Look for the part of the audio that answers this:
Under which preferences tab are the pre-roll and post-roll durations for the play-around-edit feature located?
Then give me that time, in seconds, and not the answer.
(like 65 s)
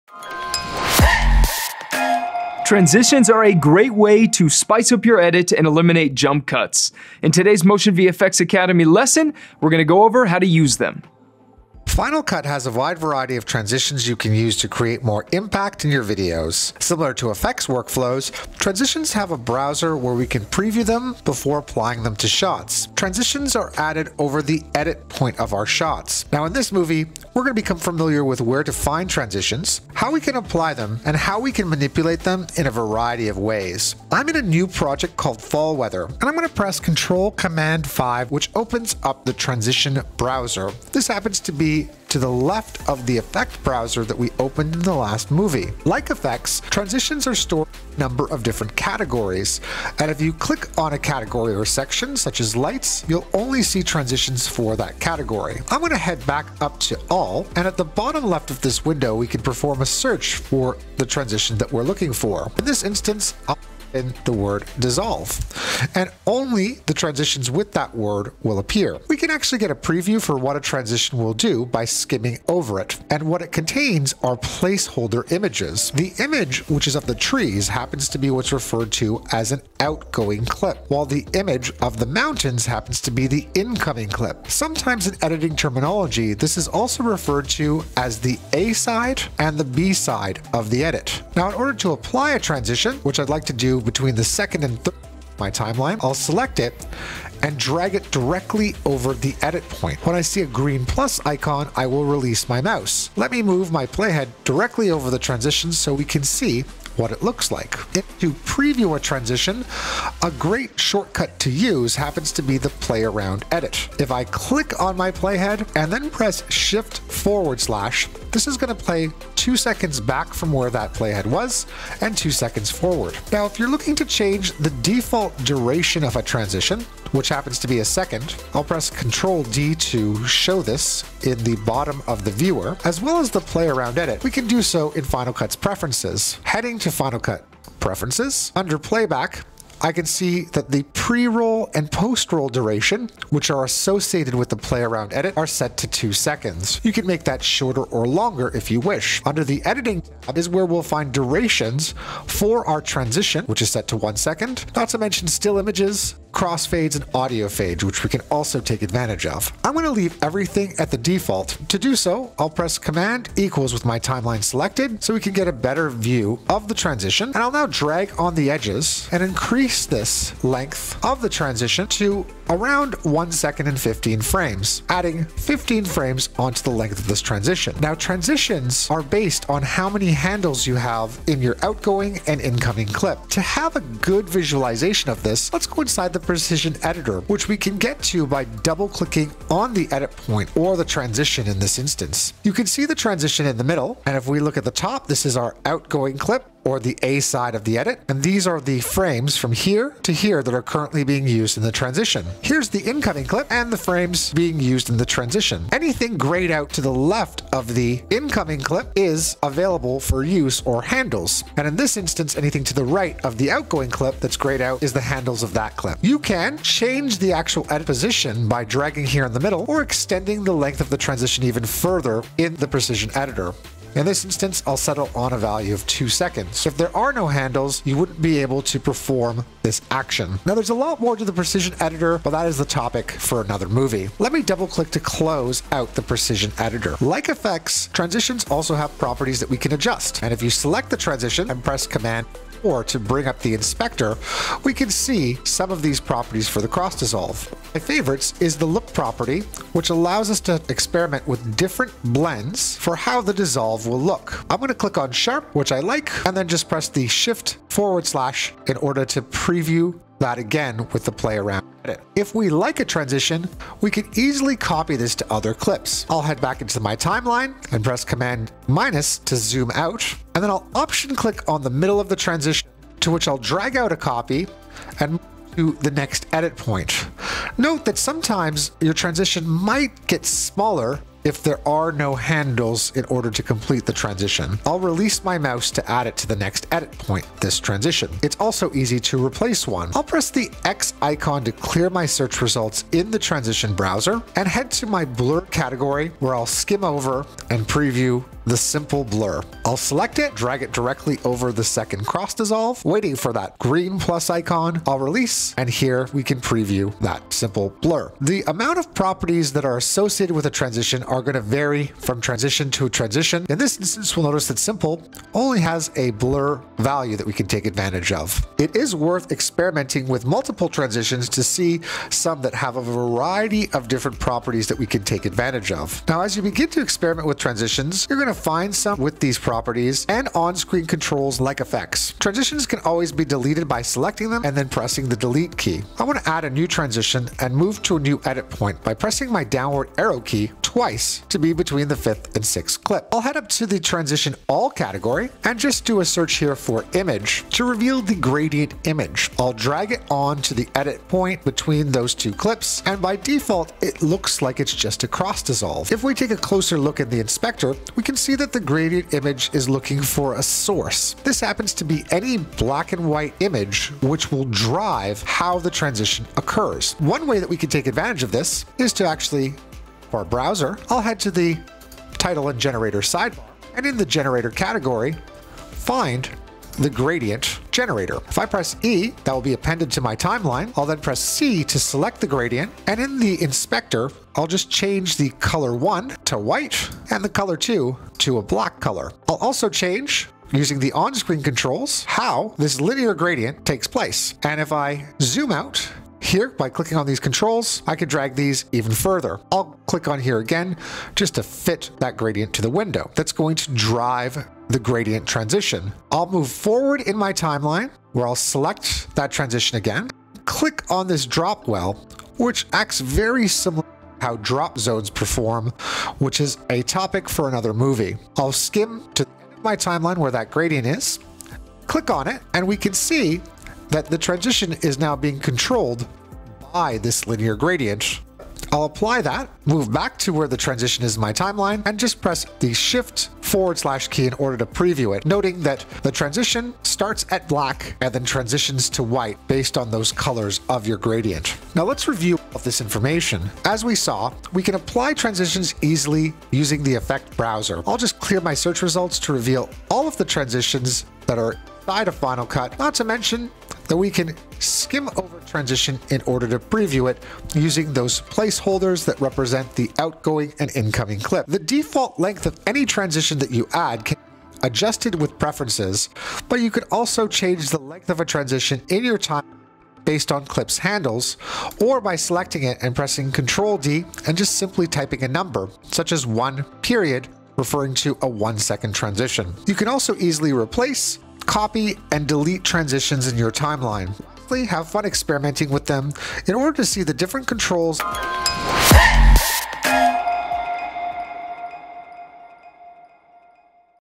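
138 s.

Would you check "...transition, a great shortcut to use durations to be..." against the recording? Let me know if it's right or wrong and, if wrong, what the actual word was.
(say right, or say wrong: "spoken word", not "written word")
wrong: "happens", not "durations".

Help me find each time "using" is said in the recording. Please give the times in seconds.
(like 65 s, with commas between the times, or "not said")
390 s, 446 s, 457 s.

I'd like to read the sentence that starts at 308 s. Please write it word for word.
The amount of properties that are associated with a transition are going to vary from transition to transition.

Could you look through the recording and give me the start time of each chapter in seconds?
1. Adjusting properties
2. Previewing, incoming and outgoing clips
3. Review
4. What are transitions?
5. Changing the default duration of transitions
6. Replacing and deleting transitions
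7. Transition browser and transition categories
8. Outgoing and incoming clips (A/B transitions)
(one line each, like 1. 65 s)
1. 238 s
2. 69 s
3. 441 s
4. 11 s
5. 122 s
6. 288 s
7. 33 s
8. 178 s.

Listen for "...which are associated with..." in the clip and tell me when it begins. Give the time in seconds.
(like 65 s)
143 s.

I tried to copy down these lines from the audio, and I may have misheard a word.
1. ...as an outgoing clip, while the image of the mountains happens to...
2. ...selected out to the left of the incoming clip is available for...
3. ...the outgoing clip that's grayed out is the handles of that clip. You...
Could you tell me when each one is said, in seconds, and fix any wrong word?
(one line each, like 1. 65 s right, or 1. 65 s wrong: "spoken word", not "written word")
1. 79 s right
2. 206 s wrong: "grayed", not "selected"
3. 213 s right.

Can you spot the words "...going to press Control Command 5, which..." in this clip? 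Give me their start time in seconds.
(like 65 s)
36 s.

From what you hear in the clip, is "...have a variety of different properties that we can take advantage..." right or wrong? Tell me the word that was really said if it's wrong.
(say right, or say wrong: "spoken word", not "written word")
right.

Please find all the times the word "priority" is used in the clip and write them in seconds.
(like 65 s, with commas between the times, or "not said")
not said.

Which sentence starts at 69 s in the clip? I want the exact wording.
We can actually get a preview for what a transition will do by skimming over it.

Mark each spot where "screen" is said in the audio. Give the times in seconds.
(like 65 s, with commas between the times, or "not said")
330 s, 390 s.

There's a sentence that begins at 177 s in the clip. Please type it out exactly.
Now, transitions are based on how many handles you have in your outgoing and incoming clip.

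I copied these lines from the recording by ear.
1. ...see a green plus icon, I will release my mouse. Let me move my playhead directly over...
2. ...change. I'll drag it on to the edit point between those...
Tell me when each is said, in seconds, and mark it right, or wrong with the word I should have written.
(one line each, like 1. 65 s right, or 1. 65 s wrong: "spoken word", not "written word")
1. 100 s right
2. 348 s wrong: "image", not "change".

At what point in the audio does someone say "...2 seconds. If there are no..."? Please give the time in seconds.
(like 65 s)
225 s.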